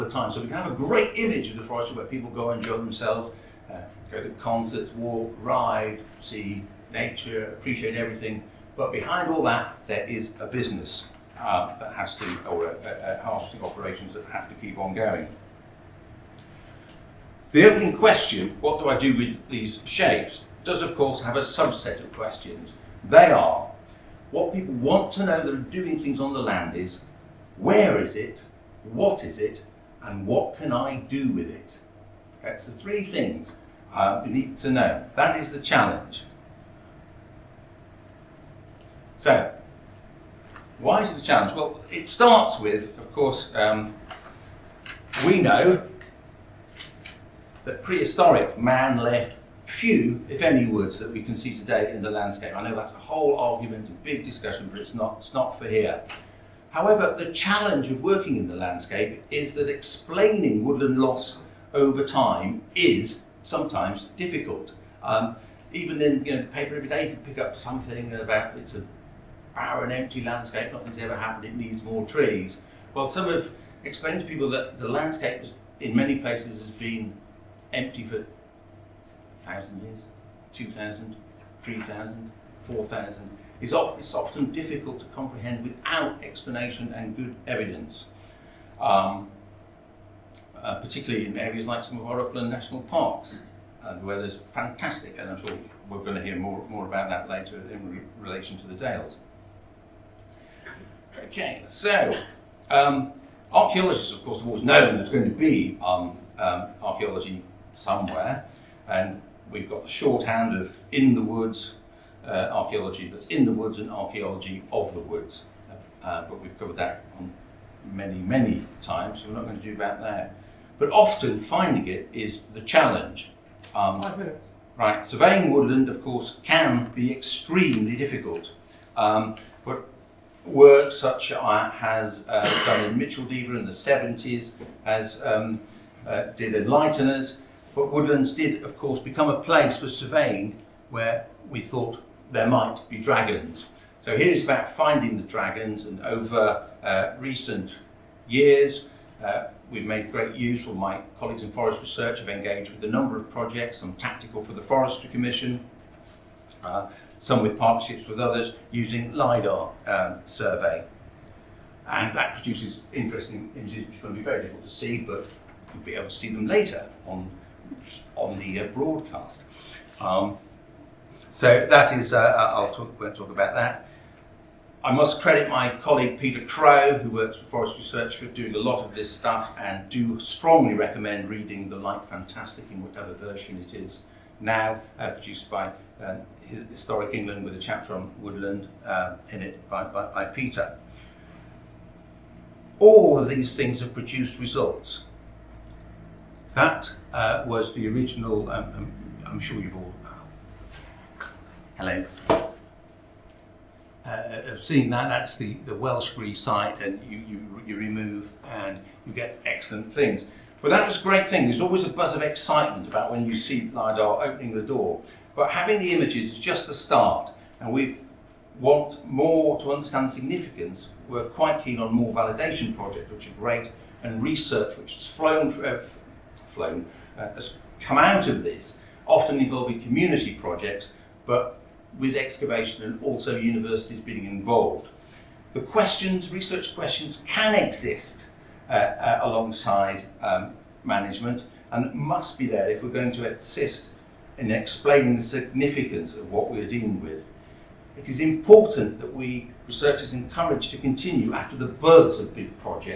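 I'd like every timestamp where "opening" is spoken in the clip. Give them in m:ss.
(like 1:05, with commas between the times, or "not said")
0:17, 3:34.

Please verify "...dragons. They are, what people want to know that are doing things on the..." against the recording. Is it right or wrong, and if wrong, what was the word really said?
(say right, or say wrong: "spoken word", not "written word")
wrong: "questions", not "dragons".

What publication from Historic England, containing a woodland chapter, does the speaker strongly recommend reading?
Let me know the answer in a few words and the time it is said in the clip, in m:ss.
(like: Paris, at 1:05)
The Light Fantastic, at 3:01.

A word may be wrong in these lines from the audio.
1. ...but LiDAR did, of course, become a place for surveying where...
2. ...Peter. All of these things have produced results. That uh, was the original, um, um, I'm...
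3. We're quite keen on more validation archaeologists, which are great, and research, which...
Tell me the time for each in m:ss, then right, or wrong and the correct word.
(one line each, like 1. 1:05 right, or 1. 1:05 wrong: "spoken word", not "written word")
1. 2:17 wrong: "Woodlands", not "LiDAR"
2. 3:10 right
3. 3:41 wrong: "projects", not "archaeologists".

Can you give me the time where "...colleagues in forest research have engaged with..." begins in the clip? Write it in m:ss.
2:31.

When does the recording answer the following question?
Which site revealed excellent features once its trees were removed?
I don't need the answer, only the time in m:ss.
3:25.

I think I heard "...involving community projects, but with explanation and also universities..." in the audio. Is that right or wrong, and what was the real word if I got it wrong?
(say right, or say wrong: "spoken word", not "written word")
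wrong: "excavation", not "explanation".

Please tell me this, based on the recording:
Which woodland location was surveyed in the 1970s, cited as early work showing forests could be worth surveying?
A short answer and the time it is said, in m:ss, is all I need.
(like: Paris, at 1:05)
Micheldever, at 2:12.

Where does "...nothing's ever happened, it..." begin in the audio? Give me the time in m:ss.
1:10.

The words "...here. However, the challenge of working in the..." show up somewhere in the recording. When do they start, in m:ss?
0:55.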